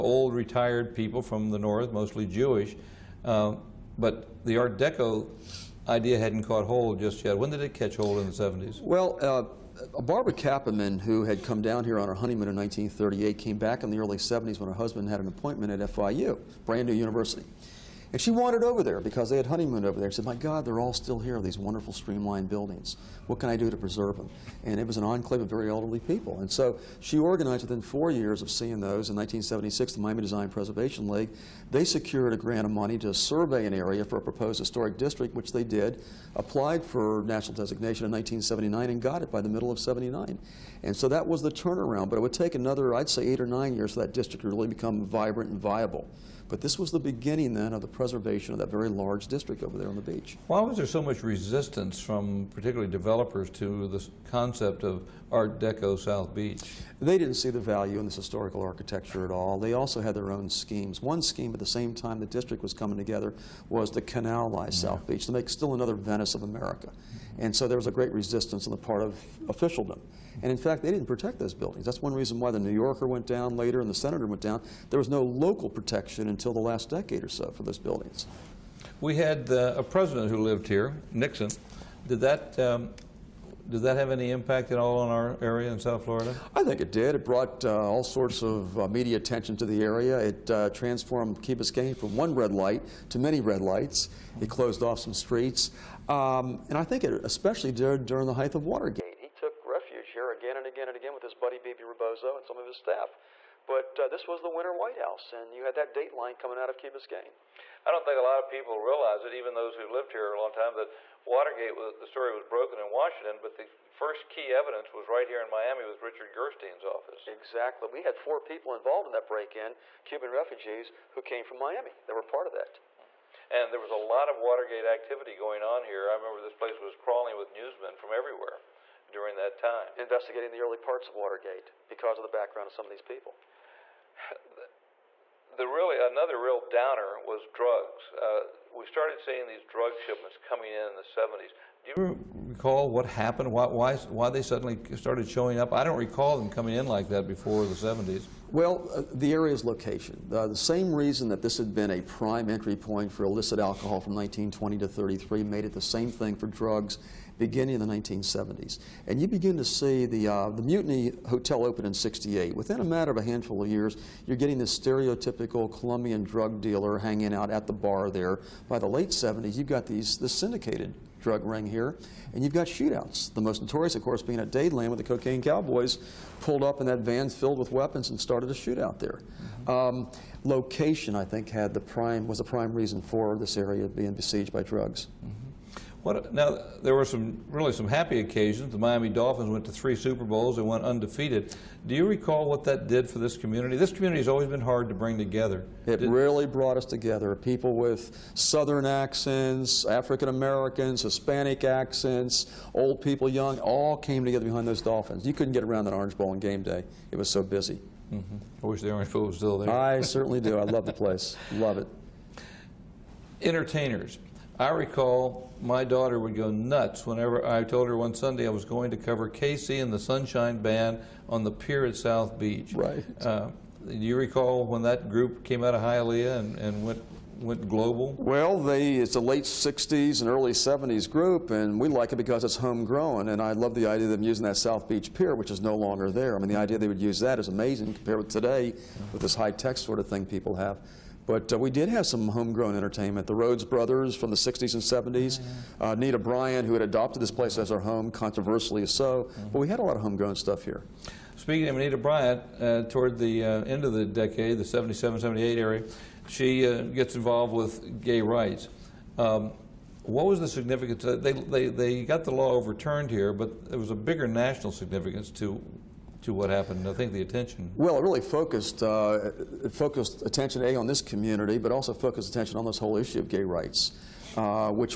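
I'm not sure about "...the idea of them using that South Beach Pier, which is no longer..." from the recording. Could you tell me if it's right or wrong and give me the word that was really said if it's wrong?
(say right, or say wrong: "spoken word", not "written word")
right.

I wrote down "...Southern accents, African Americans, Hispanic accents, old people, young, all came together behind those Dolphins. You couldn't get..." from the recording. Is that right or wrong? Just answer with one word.
right.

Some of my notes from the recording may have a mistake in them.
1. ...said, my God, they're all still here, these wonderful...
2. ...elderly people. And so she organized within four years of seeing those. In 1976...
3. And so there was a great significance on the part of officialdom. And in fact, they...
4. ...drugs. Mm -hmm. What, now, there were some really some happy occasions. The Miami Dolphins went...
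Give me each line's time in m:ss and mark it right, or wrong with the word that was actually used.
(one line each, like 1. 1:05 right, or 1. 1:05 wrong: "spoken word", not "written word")
1. 0:20 right
2. 0:25 right
3. 1:07 wrong: "resistance", not "significance"
4. 3:04 right.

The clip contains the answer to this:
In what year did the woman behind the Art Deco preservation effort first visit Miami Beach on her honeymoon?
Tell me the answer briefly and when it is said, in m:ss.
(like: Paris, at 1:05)
1938, at 0:12.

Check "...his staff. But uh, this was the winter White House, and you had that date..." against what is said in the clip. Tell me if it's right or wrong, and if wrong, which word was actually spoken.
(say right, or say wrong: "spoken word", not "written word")
right.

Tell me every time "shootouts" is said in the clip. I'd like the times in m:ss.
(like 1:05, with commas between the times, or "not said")
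2:52, 2:58.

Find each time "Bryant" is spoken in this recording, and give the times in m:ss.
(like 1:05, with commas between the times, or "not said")
4:06, 4:11.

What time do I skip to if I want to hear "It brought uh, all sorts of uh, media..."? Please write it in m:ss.
1:27.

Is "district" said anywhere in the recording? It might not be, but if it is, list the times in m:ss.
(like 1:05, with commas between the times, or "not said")
0:34, 0:44, 0:49, 1:02.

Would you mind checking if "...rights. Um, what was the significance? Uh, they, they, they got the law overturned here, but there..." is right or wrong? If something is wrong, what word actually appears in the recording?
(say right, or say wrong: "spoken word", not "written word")
right.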